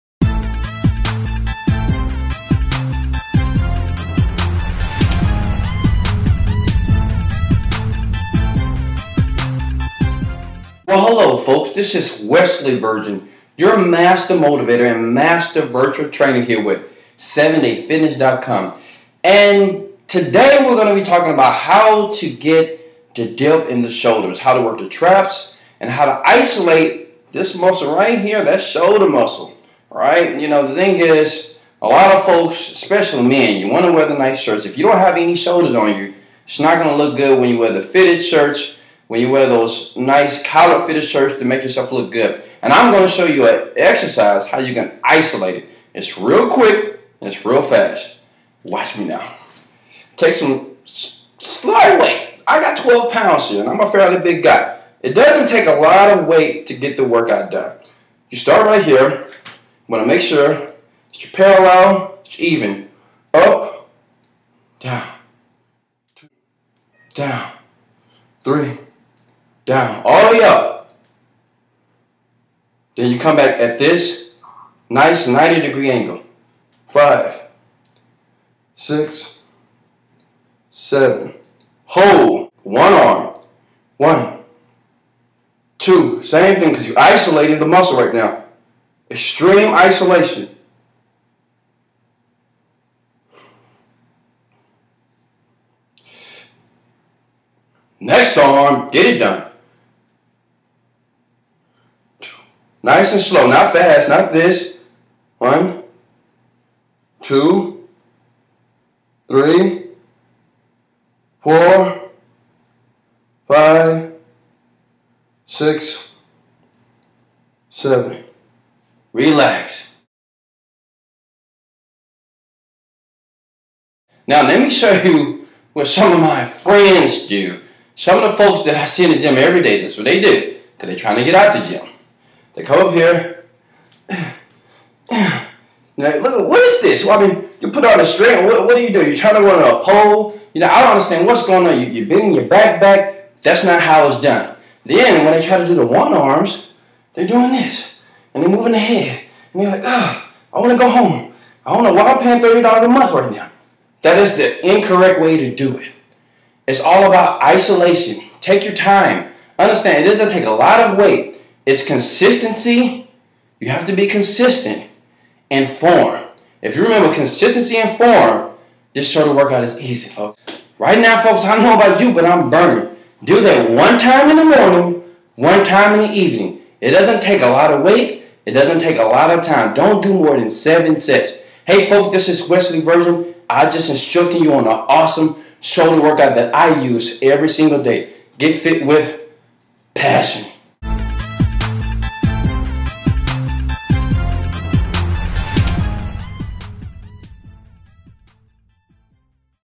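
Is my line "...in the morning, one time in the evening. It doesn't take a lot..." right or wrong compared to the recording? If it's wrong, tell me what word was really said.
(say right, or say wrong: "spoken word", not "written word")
right.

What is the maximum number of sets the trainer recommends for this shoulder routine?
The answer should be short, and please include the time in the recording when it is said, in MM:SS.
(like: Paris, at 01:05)
7, at 03:00.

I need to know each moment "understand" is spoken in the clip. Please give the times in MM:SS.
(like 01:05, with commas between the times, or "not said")
02:20, 02:39.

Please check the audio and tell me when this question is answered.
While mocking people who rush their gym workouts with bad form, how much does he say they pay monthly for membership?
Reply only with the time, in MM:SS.
02:32.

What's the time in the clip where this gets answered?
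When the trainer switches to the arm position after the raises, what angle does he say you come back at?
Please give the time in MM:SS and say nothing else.
01:15.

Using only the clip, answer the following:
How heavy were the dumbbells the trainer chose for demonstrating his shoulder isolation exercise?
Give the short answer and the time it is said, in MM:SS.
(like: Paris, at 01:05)
12 pounds, at 00:52.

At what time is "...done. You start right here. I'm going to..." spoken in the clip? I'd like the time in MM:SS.
00:57.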